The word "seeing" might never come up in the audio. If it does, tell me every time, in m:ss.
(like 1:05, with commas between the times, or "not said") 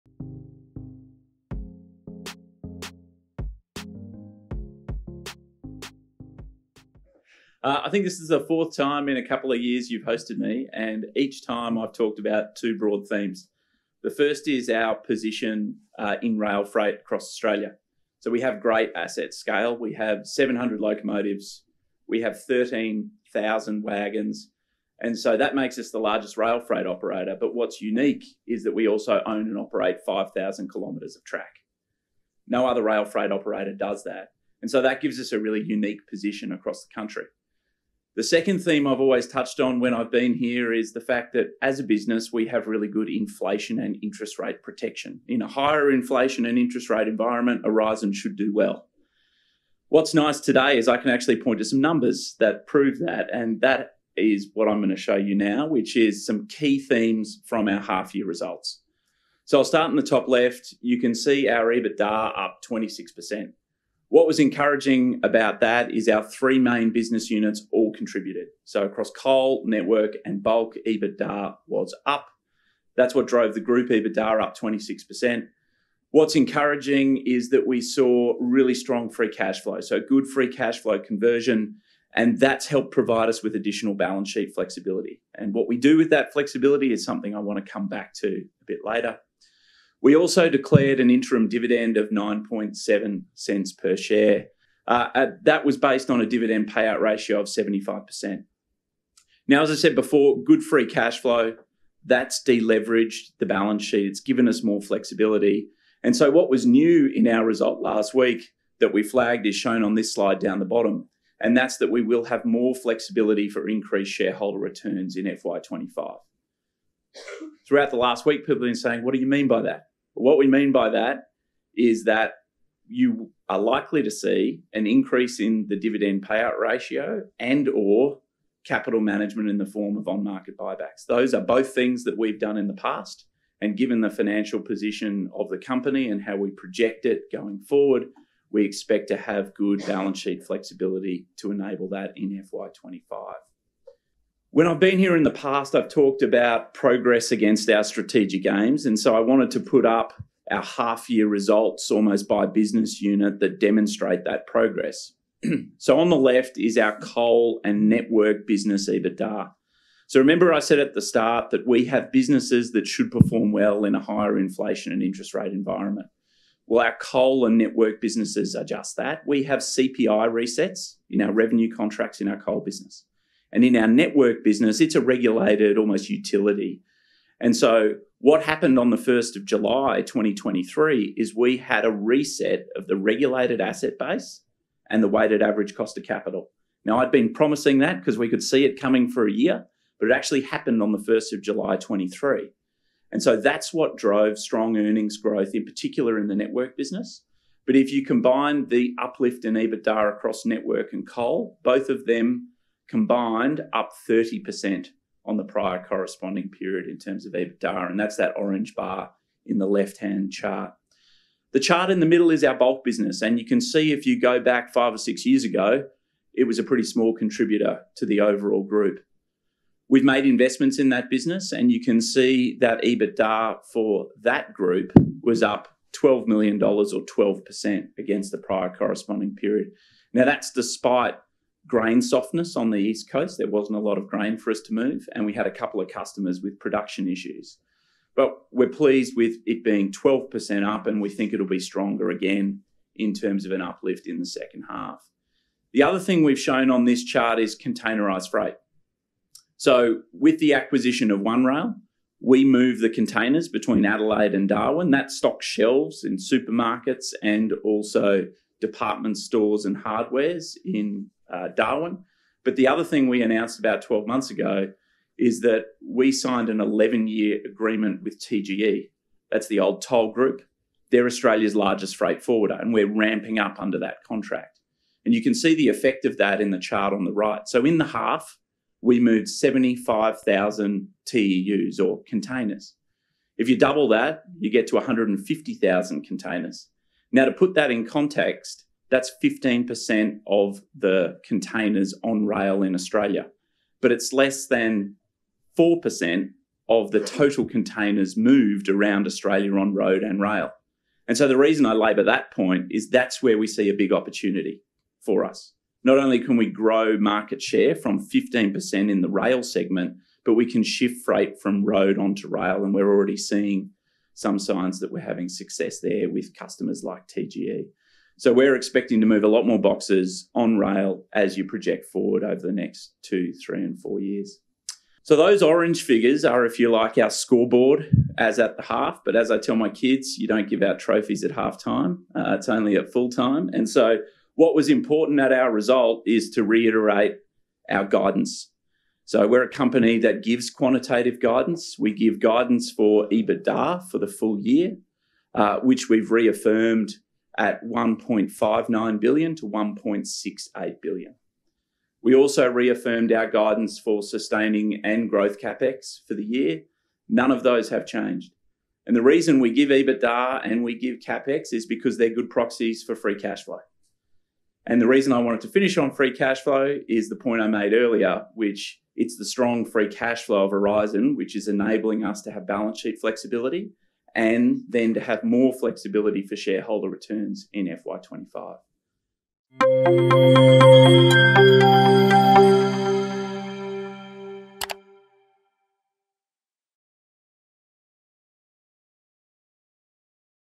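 5:13.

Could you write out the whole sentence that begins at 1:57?
Throughout the last week, people have been saying, What do you mean by that?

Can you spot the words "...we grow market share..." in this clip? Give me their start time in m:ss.
5:06.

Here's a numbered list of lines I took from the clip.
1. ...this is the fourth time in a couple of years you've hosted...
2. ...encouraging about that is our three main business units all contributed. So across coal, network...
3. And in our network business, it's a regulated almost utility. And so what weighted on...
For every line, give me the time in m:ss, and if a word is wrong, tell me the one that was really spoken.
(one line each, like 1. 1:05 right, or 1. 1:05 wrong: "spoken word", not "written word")
1. 0:08 right
2. 1:04 right
3. 2:53 wrong: "happened", not "weighted".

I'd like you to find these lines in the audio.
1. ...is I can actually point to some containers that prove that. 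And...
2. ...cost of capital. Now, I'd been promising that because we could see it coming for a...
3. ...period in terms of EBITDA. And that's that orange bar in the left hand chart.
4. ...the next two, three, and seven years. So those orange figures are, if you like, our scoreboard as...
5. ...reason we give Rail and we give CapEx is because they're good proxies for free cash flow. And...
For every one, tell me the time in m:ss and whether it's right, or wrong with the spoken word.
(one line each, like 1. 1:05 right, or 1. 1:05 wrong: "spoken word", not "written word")
1. 0:50 wrong: "numbers", not "containers"
2. 3:05 right
3. 3:26 right
4. 5:22 wrong: "four", not "seven"
5. 5:59 wrong: "EBITDA", not "Rail".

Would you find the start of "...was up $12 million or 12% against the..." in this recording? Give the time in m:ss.
3:45.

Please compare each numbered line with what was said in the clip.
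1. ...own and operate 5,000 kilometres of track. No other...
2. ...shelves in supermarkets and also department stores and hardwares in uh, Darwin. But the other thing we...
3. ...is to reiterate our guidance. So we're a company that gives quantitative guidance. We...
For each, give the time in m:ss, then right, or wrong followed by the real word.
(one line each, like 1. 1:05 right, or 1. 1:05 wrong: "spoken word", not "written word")
1. 0:29 right
2. 4:15 right
3. 5:36 right.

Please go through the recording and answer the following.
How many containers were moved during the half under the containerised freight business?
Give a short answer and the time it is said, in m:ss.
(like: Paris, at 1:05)
75,000, at 4:39.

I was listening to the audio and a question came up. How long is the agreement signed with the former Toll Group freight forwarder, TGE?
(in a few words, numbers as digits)
11 years.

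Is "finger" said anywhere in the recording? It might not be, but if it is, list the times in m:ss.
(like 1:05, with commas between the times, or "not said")
not said.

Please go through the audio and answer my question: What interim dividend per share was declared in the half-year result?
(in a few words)
9.7 cents.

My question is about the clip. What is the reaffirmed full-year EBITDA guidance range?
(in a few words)
1.59 billion to 1.68 billion.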